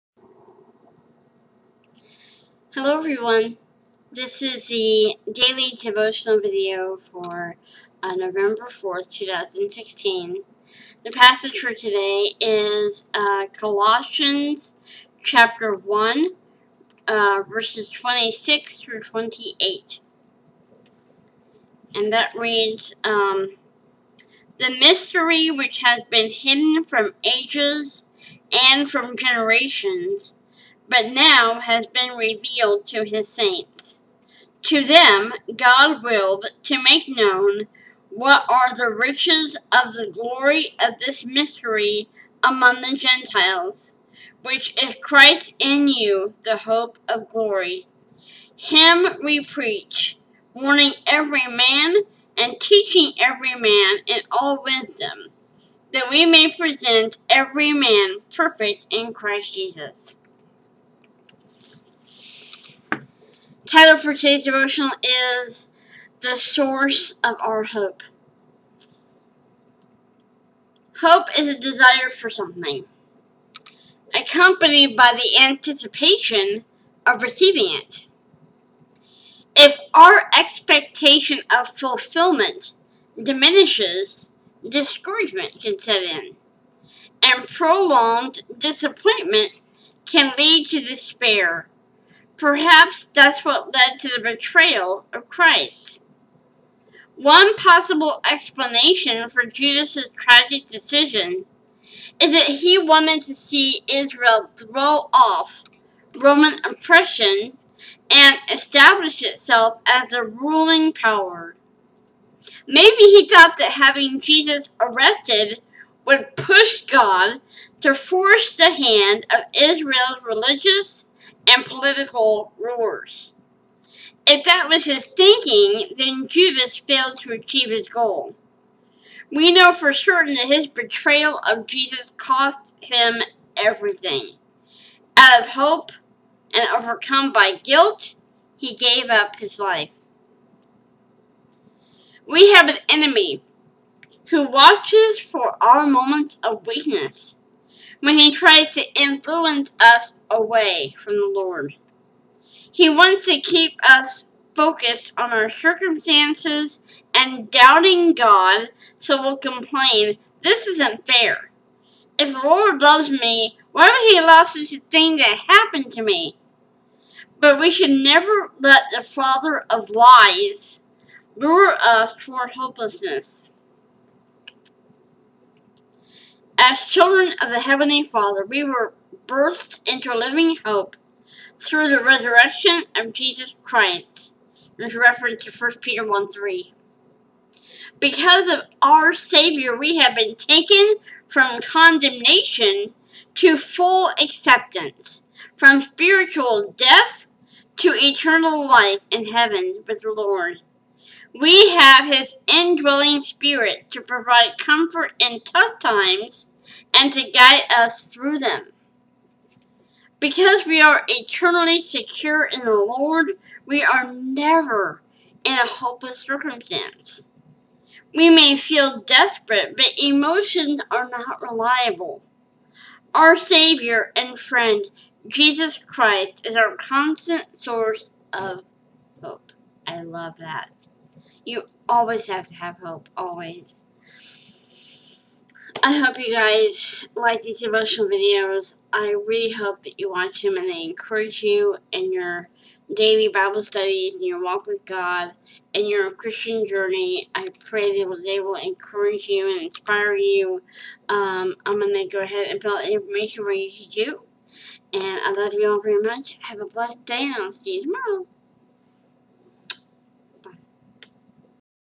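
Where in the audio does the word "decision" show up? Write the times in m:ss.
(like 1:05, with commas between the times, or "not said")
1:40.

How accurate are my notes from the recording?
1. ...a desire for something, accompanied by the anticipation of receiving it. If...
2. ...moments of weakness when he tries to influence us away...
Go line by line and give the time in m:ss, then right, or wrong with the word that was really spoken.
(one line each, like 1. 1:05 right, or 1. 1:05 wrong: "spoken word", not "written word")
1. 1:11 right
2. 2:25 right.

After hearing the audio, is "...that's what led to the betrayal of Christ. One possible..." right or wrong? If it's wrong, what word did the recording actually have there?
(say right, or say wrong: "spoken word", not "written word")
right.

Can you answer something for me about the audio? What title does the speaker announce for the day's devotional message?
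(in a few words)
The Source of Our Hope.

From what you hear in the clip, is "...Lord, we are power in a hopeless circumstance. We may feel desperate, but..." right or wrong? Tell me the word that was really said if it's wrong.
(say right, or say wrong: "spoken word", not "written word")
wrong: "never", not "power".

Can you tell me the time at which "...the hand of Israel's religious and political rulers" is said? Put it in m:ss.
1:58.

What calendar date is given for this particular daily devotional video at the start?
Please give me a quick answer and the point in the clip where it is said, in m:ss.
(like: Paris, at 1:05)
November 4th, 2016, at 0:08.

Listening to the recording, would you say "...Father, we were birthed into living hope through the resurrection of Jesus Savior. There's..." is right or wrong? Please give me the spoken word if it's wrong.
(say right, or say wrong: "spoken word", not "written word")
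wrong: "Christ", not "Savior".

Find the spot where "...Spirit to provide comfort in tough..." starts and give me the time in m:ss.
3:23.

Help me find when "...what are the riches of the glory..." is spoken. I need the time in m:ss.
0:38.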